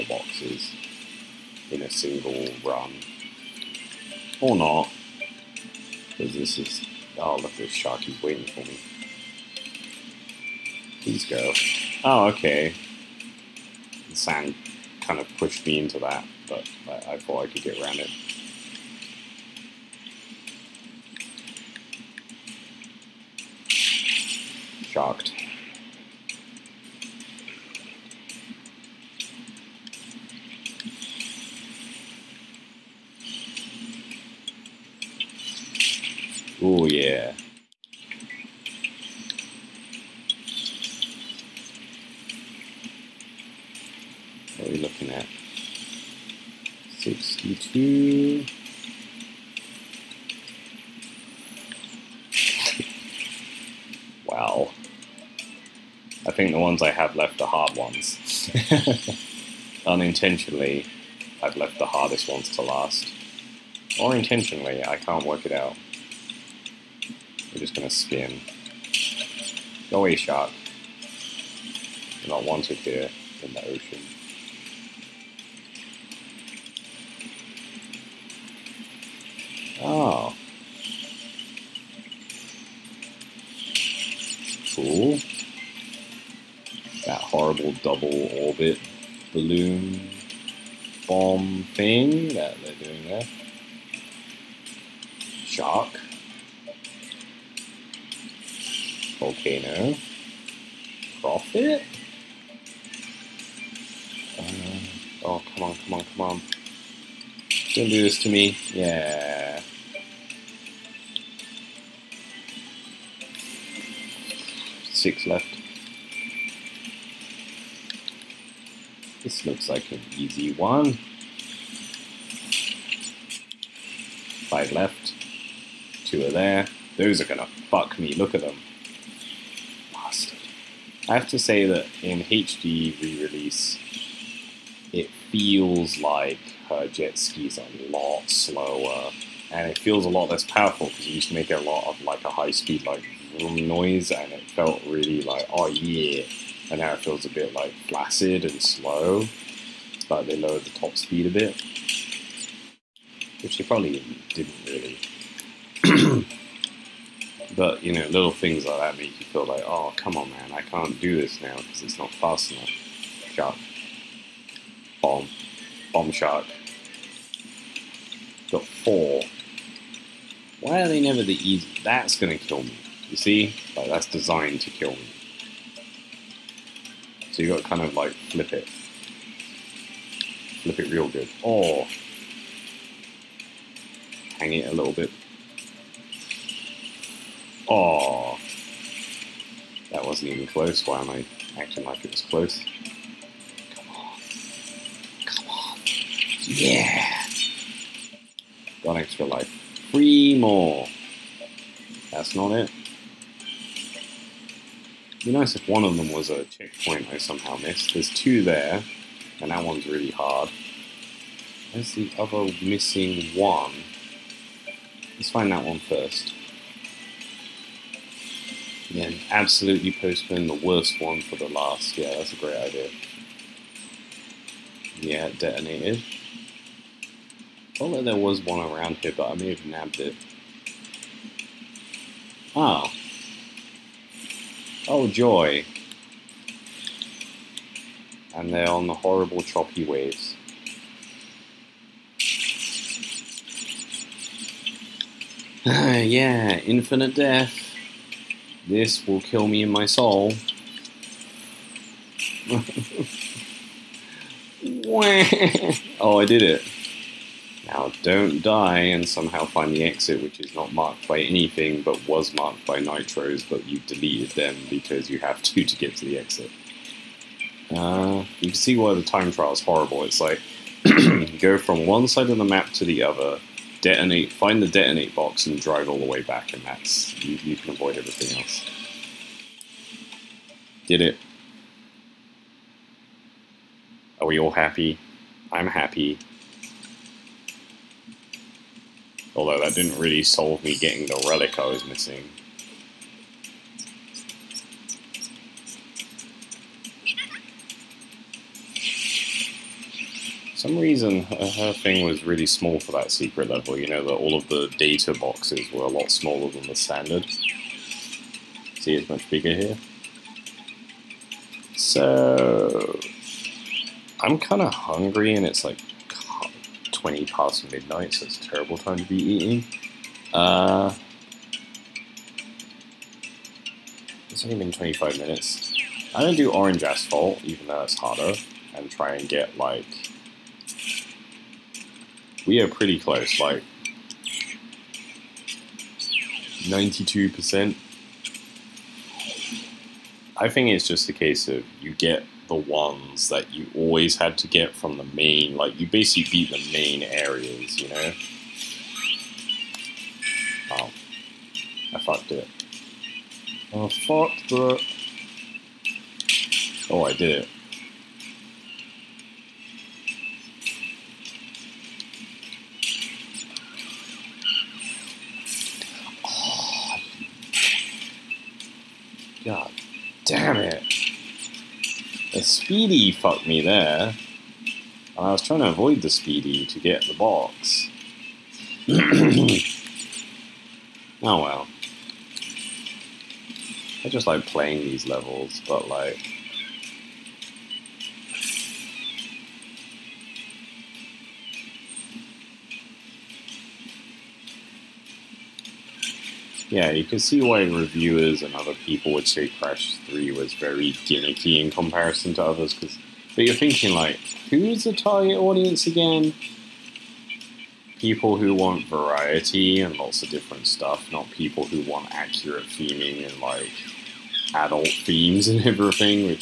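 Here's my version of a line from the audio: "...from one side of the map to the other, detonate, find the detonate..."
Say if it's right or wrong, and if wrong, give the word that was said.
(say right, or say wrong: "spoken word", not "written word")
right.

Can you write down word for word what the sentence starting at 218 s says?
And then absolutely postpone the worst one for the last.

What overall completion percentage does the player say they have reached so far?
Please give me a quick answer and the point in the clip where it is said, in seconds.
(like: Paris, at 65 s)
92%, at 336 s.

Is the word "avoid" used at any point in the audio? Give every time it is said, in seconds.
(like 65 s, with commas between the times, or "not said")
277 s, 375 s.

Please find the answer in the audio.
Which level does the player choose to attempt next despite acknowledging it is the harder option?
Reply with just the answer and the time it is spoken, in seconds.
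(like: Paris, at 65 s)
Orange Asphalt, at 326 s.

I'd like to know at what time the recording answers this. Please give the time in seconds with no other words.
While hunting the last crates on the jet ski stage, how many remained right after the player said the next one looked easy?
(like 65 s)
124 s.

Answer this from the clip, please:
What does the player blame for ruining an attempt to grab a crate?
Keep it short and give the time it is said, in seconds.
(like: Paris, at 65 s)
A speedy, at 372 s.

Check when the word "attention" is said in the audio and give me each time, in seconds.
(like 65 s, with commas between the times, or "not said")
not said.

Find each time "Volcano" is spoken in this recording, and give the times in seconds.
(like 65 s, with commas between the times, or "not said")
99 s.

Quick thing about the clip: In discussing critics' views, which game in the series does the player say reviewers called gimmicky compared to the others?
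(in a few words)
Crash 3.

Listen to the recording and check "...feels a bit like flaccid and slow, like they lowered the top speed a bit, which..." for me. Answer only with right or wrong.
right.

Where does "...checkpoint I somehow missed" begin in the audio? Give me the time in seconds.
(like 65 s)
206 s.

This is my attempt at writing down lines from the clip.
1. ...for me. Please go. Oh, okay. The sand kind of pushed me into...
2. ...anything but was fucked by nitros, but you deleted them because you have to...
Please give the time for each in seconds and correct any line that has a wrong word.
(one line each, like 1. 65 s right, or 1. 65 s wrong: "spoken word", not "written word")
1. 8 s right
2. 261 s wrong: "marked", not "fucked".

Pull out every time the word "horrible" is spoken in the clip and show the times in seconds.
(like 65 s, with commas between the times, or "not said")
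238 s, 269 s.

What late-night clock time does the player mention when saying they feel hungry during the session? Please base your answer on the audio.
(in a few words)
20 past midnight.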